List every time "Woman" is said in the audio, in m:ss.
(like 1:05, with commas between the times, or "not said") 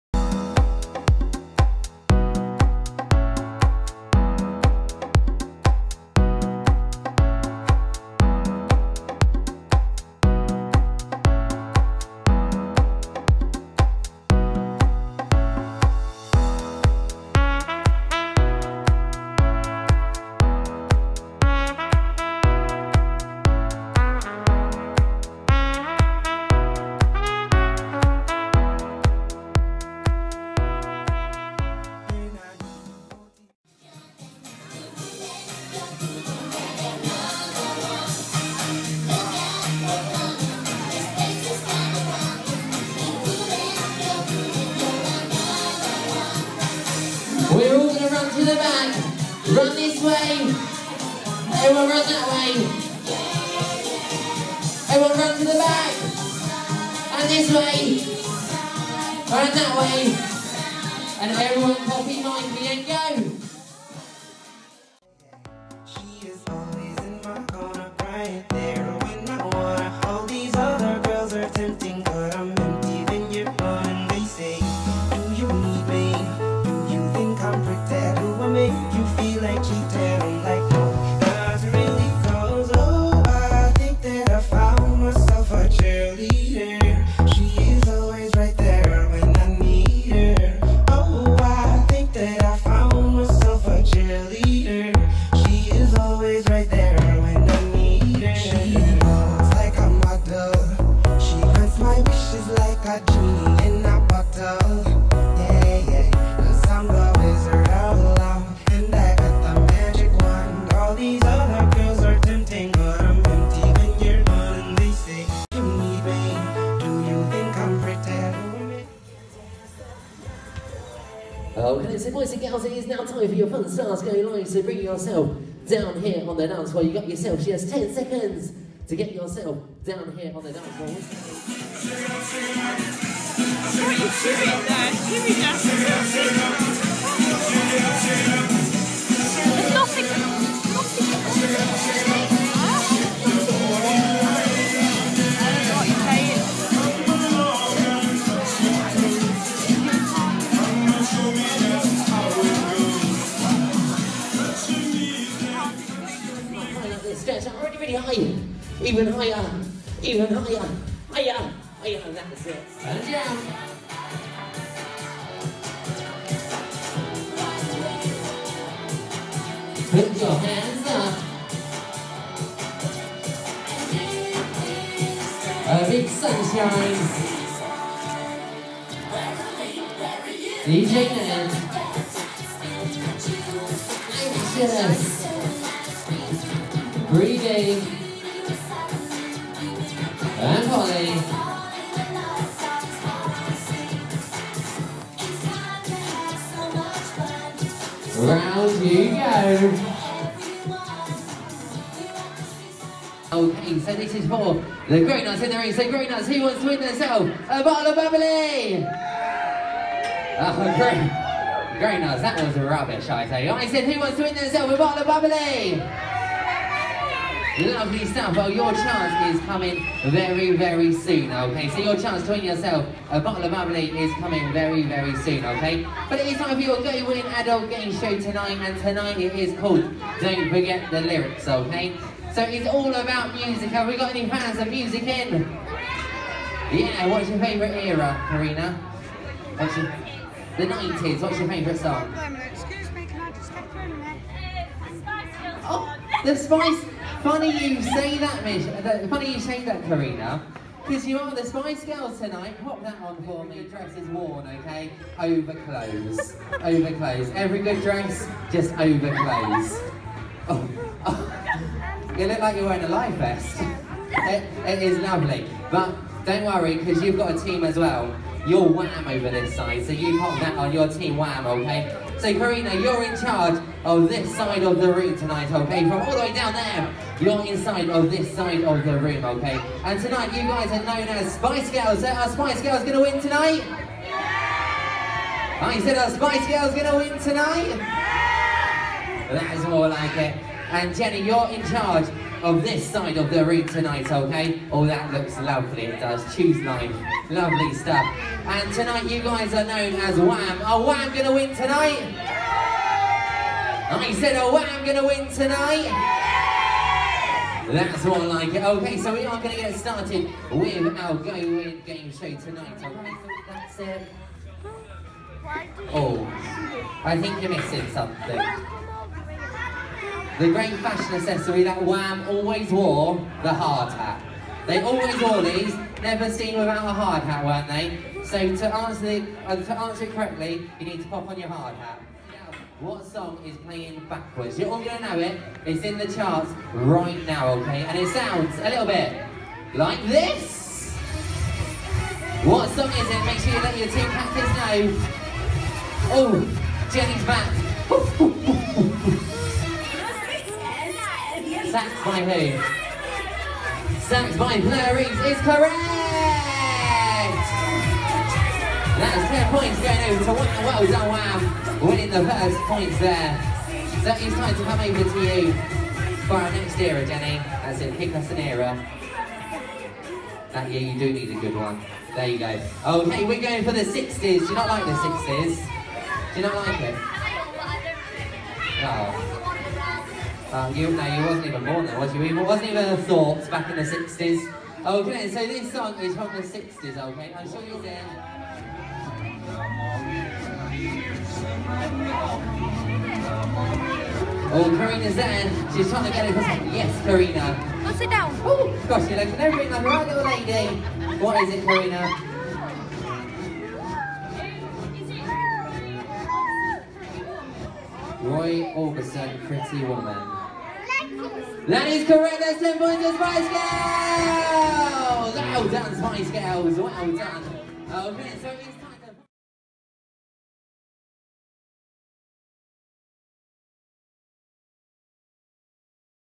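6:49.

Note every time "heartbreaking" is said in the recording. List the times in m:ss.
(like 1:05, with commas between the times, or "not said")
not said.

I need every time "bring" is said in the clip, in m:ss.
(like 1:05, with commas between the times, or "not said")
2:04.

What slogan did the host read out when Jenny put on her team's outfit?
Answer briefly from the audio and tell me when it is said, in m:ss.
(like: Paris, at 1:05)
Choose life, at 4:56.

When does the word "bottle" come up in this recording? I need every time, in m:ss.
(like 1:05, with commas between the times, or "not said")
3:27, 3:34, 3:43.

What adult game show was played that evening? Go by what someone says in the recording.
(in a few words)
Don't Forget the Lyrics.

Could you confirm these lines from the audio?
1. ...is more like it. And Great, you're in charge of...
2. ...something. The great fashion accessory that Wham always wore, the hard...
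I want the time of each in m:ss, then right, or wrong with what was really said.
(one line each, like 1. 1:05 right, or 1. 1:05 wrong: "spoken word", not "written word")
1. 4:49 wrong: "Jenny", not "Great"
2. 5:17 right.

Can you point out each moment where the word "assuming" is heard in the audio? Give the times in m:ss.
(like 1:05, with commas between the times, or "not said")
not said.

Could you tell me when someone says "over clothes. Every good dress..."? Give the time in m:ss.
4:16.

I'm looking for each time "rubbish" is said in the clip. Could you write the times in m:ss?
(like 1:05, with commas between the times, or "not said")
3:32.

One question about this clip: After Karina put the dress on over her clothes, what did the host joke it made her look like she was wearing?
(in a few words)
a life vest.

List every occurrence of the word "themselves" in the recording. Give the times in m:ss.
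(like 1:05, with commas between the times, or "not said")
3:26, 3:34.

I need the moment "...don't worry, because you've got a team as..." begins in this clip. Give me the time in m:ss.
4:26.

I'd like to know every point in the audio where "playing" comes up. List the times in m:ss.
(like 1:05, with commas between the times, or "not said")
5:33.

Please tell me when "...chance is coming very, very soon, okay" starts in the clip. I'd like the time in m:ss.
3:38.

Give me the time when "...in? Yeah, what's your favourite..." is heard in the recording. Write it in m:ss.
3:55.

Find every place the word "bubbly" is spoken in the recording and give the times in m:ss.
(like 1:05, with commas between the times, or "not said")
3:27, 3:35, 3:43.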